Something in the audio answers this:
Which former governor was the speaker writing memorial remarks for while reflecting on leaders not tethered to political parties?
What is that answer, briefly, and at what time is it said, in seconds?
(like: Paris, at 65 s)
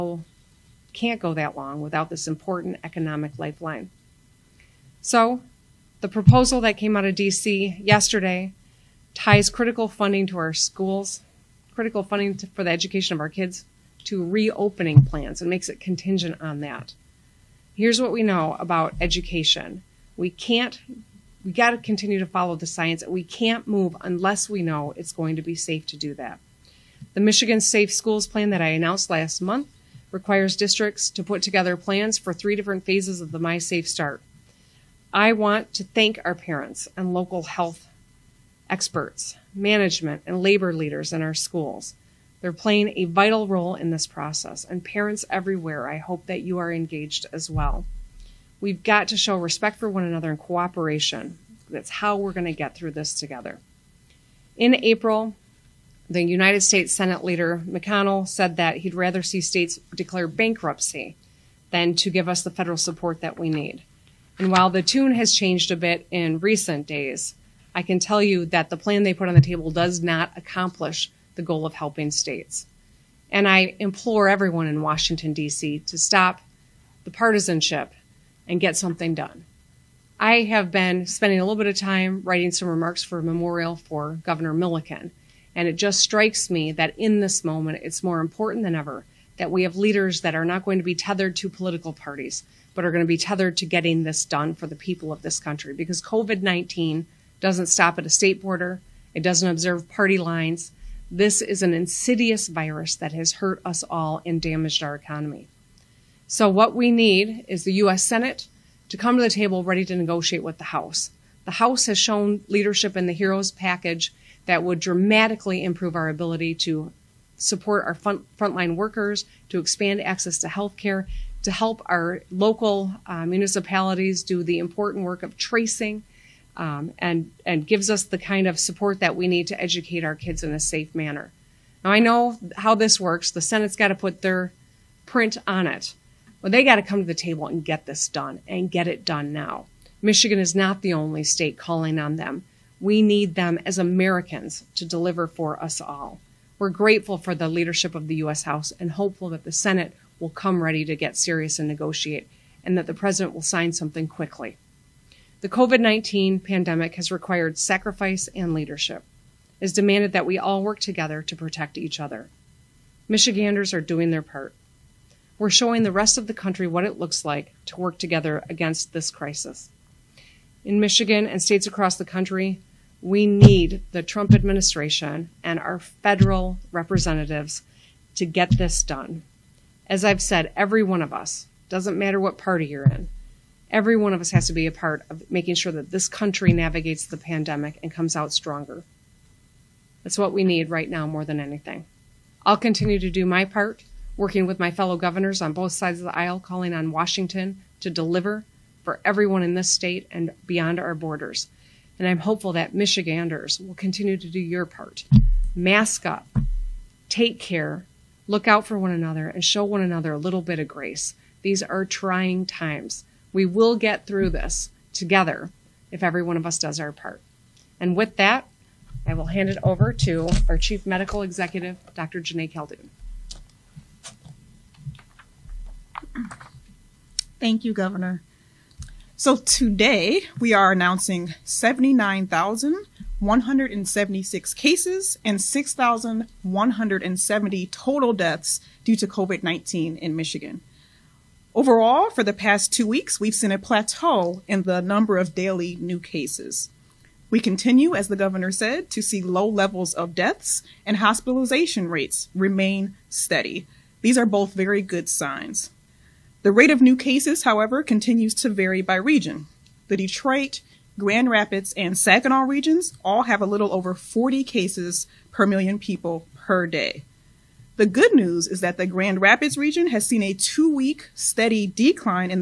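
Governor Milliken, at 84 s.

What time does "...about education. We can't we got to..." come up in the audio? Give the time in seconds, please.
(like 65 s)
18 s.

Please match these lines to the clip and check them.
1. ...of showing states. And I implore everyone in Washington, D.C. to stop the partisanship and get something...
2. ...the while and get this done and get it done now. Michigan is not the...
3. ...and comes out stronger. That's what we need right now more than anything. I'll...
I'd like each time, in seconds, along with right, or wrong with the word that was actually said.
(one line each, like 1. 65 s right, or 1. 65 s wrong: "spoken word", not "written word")
1. 71 s wrong: "helping", not "showing"
2. 137 s wrong: "table", not "while"
3. 187 s right.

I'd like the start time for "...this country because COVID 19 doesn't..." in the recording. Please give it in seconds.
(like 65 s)
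95 s.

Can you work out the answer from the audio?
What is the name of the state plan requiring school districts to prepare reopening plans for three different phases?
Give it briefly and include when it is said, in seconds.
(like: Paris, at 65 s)
Michigan Safe Schools Plan, at 27 s.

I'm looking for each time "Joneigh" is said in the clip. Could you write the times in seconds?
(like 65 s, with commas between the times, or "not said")
222 s.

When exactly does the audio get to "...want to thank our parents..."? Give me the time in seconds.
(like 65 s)
35 s.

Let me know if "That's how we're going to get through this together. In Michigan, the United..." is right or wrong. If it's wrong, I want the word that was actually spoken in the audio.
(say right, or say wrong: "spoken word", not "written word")
wrong: "April", not "Michigan".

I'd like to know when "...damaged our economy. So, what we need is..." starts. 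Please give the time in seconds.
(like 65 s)
104 s.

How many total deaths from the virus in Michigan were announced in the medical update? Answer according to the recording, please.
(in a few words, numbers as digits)
6,170.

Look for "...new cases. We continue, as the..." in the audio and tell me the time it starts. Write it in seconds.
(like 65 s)
245 s.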